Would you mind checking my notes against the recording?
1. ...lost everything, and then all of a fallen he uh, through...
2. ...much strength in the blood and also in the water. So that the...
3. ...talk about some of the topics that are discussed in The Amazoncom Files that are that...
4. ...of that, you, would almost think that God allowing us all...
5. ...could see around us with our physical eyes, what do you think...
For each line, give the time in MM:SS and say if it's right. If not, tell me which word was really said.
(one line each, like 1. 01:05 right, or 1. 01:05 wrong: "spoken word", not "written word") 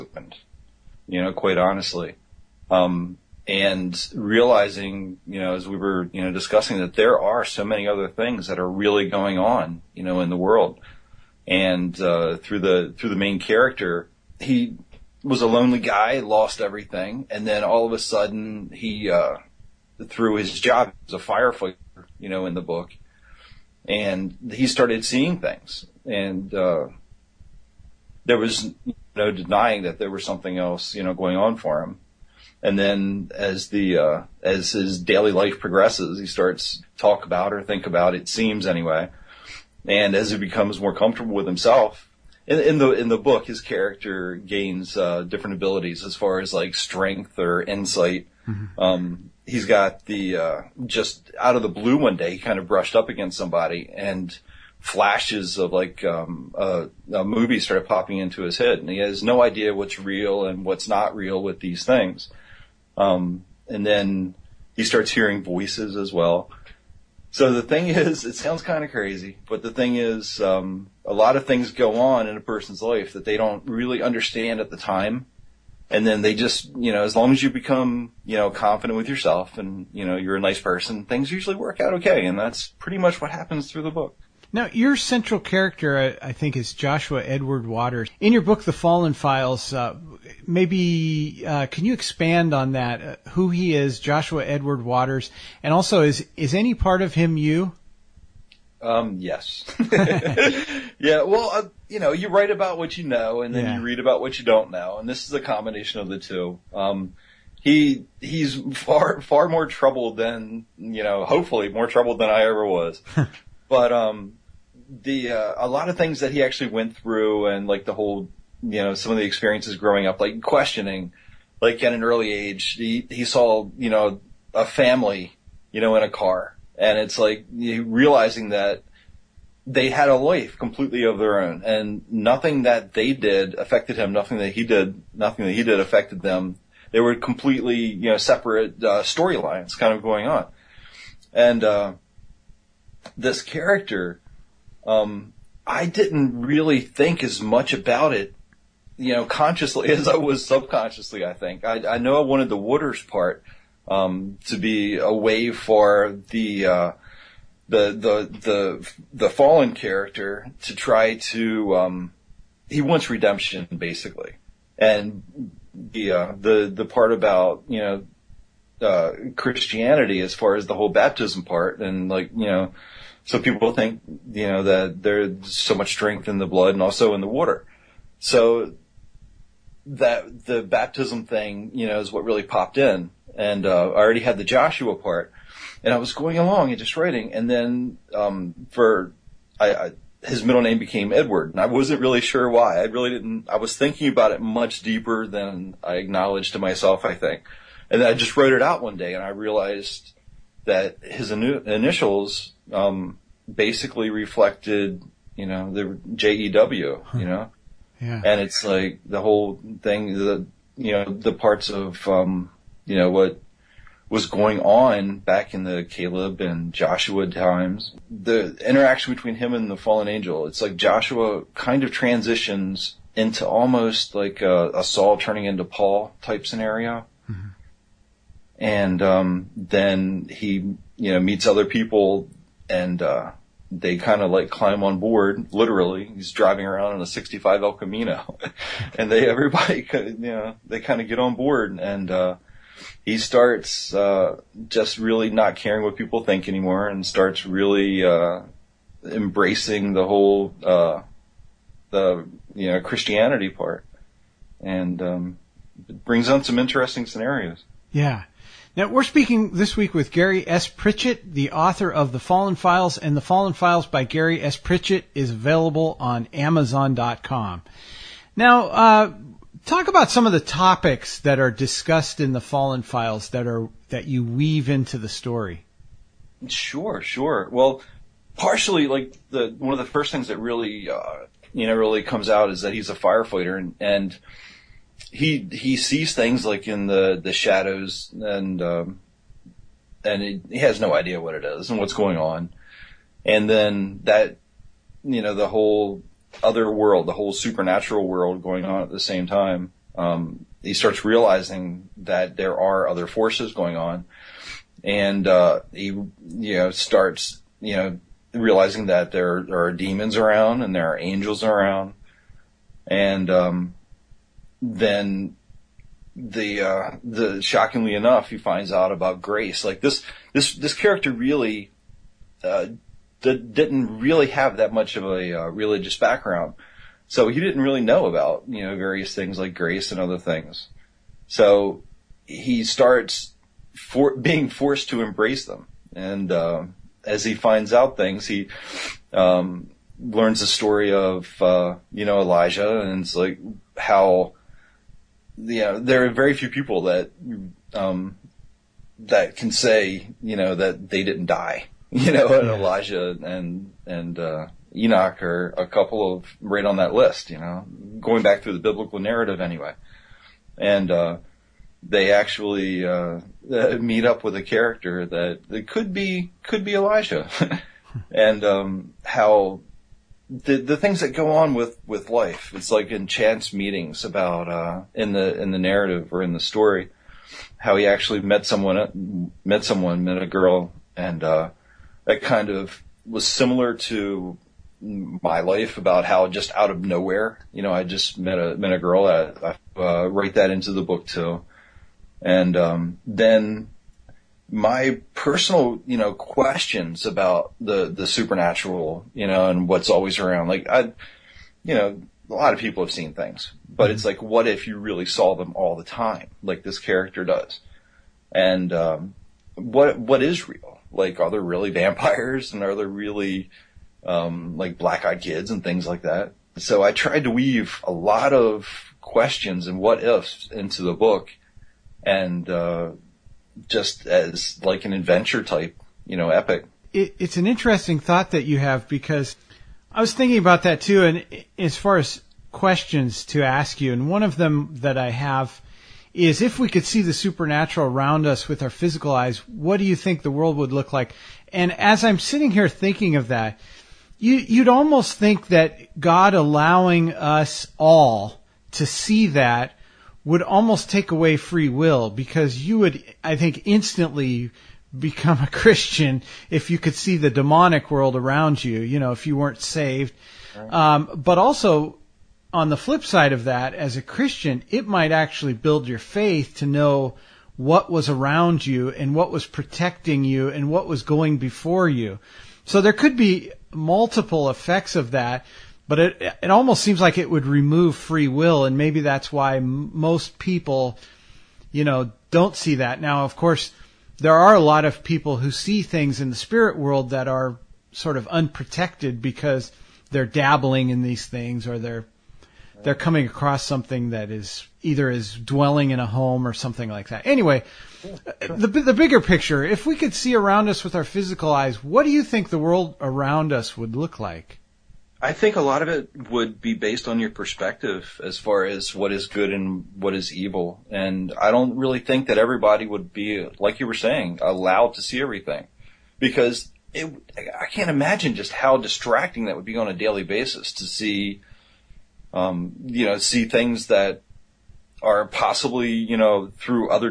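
1. 00:16 wrong: "sudden", not "fallen"
2. 02:55 right
3. 04:29 wrong: "Fallen", not "Amazoncom"
4. 07:23 right
5. 08:19 right.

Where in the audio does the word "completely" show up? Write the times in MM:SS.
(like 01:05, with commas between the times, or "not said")
02:10, 02:17.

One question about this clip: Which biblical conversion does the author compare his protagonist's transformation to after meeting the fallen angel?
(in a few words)
Saul turning into Paul.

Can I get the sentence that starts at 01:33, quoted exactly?
Uh, who he is, Joshua Edward Waters, and also is is any part of him you?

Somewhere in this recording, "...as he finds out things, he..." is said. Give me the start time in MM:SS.
05:37.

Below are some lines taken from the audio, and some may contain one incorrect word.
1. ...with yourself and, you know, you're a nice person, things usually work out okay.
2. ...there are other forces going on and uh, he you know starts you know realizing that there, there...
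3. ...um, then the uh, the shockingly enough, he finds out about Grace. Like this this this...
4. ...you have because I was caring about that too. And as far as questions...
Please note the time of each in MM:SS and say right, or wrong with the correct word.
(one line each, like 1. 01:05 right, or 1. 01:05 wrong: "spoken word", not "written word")
1. 01:18 right
2. 05:02 right
3. 05:13 right
4. 07:08 wrong: "thinking", not "caring".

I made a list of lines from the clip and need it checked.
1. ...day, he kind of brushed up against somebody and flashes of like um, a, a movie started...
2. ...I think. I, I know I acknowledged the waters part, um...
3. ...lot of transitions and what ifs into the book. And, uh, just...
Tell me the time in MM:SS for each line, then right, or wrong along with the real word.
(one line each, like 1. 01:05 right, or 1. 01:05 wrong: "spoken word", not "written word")
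1. 00:52 right
2. 02:31 wrong: "wanted", not "acknowledged"
3. 06:57 wrong: "questions", not "transitions".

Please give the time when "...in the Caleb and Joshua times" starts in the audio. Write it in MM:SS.
03:35.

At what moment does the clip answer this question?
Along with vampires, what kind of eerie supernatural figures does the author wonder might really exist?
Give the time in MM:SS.
06:54.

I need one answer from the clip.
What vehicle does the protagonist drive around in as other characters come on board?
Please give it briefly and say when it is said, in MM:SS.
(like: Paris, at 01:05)
'65 El Camino, at 03:57.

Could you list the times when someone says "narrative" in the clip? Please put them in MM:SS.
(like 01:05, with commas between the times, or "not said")
05:58, 06:15.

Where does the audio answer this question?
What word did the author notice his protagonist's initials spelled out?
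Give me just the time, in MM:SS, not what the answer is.
03:26.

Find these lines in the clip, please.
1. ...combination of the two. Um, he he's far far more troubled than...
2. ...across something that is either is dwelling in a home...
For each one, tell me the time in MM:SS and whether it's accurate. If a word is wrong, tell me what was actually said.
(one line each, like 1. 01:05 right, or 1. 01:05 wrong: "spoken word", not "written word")
1. 01:45 right
2. 08:13 right.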